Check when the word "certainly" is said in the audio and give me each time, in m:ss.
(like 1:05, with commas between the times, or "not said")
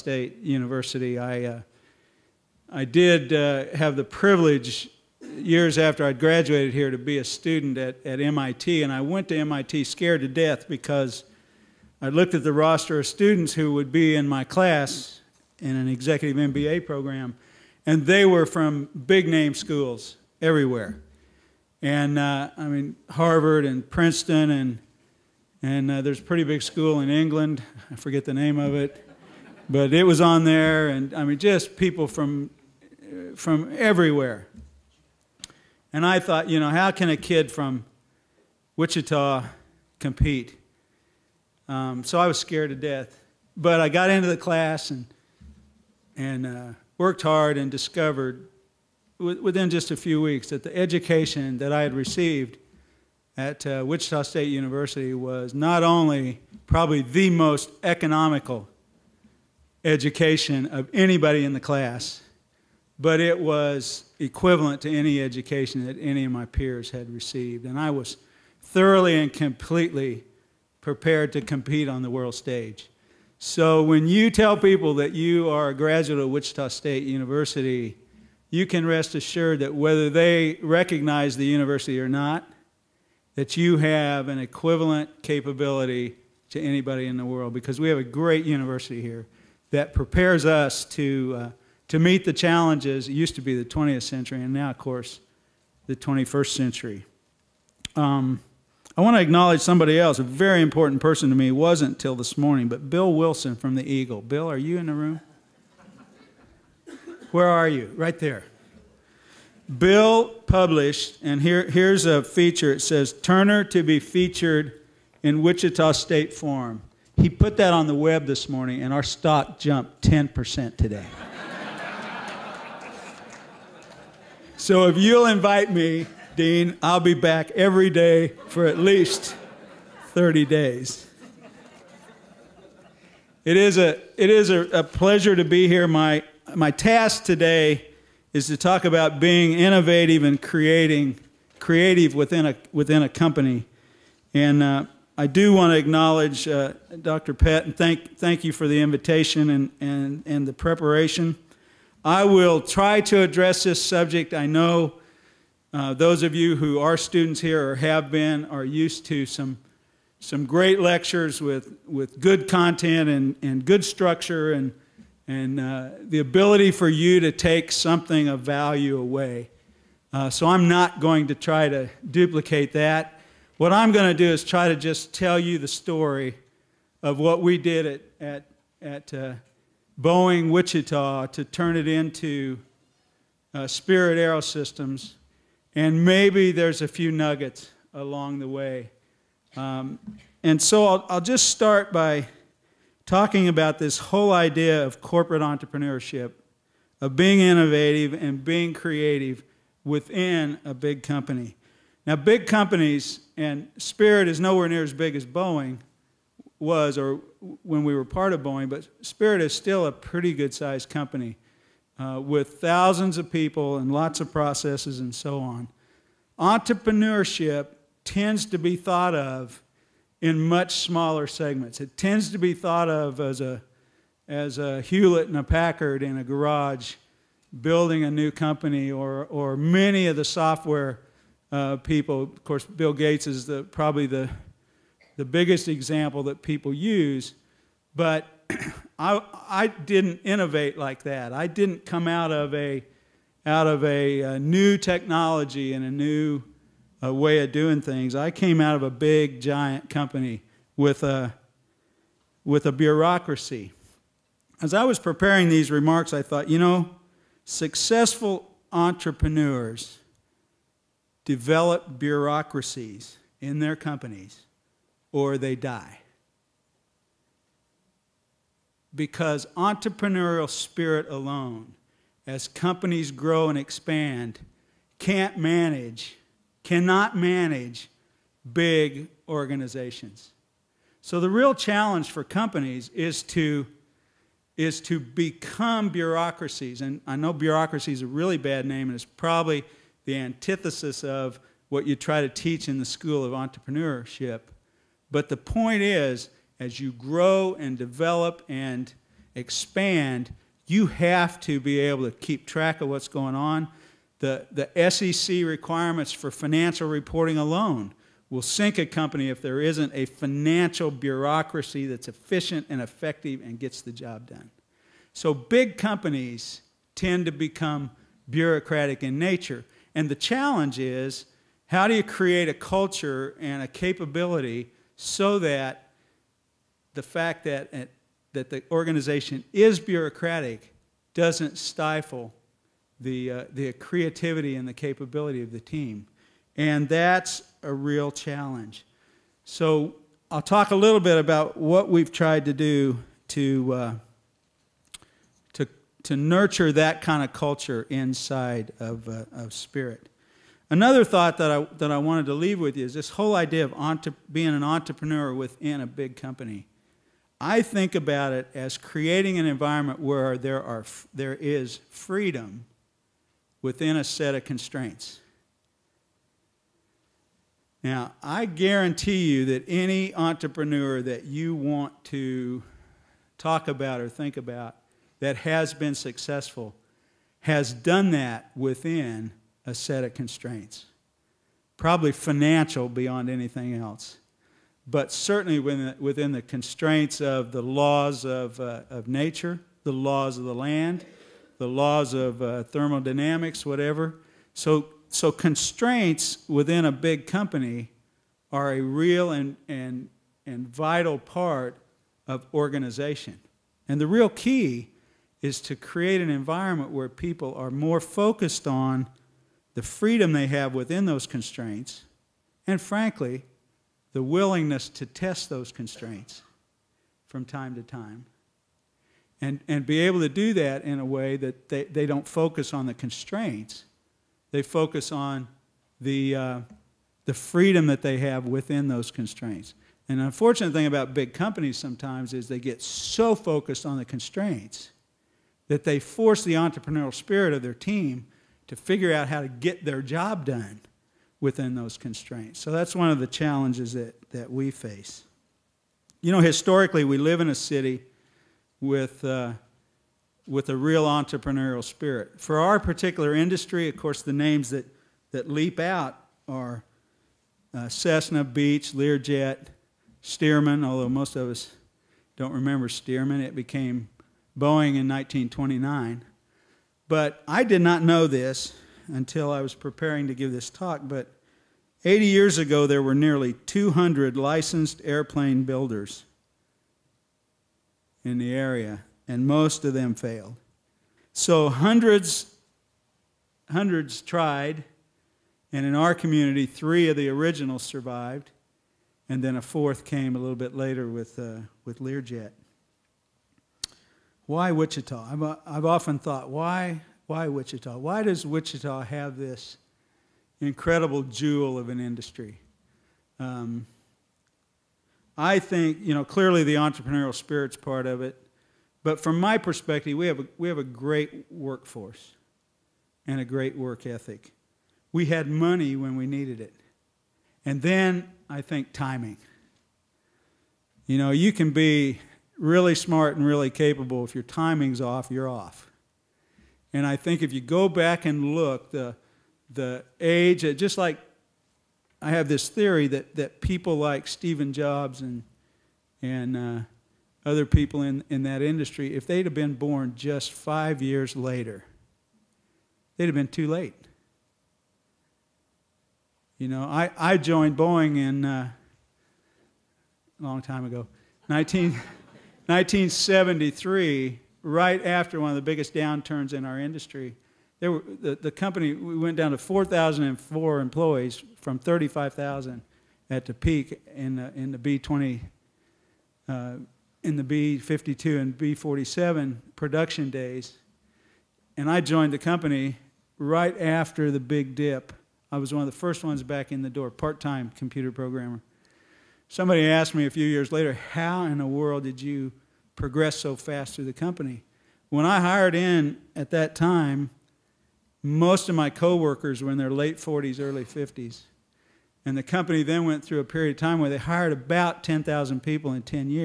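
6:25.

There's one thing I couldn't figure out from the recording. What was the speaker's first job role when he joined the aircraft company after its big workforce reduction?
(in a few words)
part-time computer programmer.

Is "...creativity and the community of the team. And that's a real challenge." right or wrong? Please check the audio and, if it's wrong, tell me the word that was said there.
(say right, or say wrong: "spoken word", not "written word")
wrong: "capability", not "community".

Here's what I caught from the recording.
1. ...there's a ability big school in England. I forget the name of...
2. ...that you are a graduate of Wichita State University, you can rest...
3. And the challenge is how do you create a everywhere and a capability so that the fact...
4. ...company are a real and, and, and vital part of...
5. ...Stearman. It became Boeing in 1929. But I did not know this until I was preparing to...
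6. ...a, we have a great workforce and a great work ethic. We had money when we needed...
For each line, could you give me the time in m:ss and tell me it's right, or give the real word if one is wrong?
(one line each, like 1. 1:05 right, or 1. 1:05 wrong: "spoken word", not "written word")
1. 0:26 wrong: "pretty", not "ability"
2. 1:14 right
3. 5:19 wrong: "culture", not "everywhere"
4. 6:37 right
5. 7:42 right
6. 8:30 right.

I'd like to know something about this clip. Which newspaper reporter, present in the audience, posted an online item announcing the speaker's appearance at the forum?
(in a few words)
Bill Wilson.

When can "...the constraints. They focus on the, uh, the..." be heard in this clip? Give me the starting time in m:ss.
7:02.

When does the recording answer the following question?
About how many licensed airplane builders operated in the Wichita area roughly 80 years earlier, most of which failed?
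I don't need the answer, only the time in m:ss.
7:53.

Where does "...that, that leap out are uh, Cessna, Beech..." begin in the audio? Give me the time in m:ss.
7:34.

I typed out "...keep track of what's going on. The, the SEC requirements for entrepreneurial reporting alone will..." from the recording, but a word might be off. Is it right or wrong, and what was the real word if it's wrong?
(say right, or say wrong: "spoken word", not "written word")
wrong: "financial", not "entrepreneurial".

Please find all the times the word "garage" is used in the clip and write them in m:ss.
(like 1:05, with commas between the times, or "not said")
3:46.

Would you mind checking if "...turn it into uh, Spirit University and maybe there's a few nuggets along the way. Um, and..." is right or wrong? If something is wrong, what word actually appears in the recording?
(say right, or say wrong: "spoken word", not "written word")
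wrong: "Aerosystems", not "University".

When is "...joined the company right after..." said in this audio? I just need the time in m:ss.
9:32.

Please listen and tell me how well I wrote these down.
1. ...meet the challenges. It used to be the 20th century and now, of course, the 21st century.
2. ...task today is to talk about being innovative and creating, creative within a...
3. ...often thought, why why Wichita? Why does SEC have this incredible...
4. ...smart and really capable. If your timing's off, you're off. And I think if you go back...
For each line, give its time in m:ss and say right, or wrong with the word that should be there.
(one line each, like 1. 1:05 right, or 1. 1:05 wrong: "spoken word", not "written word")
1. 1:31 right
2. 2:16 right
3. 8:15 wrong: "Wichita", not "SEC"
4. 8:42 right.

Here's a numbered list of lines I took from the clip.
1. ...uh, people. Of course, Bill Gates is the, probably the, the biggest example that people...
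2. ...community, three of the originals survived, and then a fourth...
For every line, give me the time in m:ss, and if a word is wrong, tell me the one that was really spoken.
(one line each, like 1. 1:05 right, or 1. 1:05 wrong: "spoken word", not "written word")
1. 3:51 right
2. 8:06 right.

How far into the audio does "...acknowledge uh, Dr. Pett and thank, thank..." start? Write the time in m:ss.
2:25.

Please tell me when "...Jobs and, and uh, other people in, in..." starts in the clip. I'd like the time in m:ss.
8:54.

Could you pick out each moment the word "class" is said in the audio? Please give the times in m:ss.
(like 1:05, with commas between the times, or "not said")
0:14, 0:44, 1:01.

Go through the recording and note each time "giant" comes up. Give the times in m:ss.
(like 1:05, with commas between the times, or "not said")
4:09.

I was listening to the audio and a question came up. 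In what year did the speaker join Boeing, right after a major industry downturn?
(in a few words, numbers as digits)
1973.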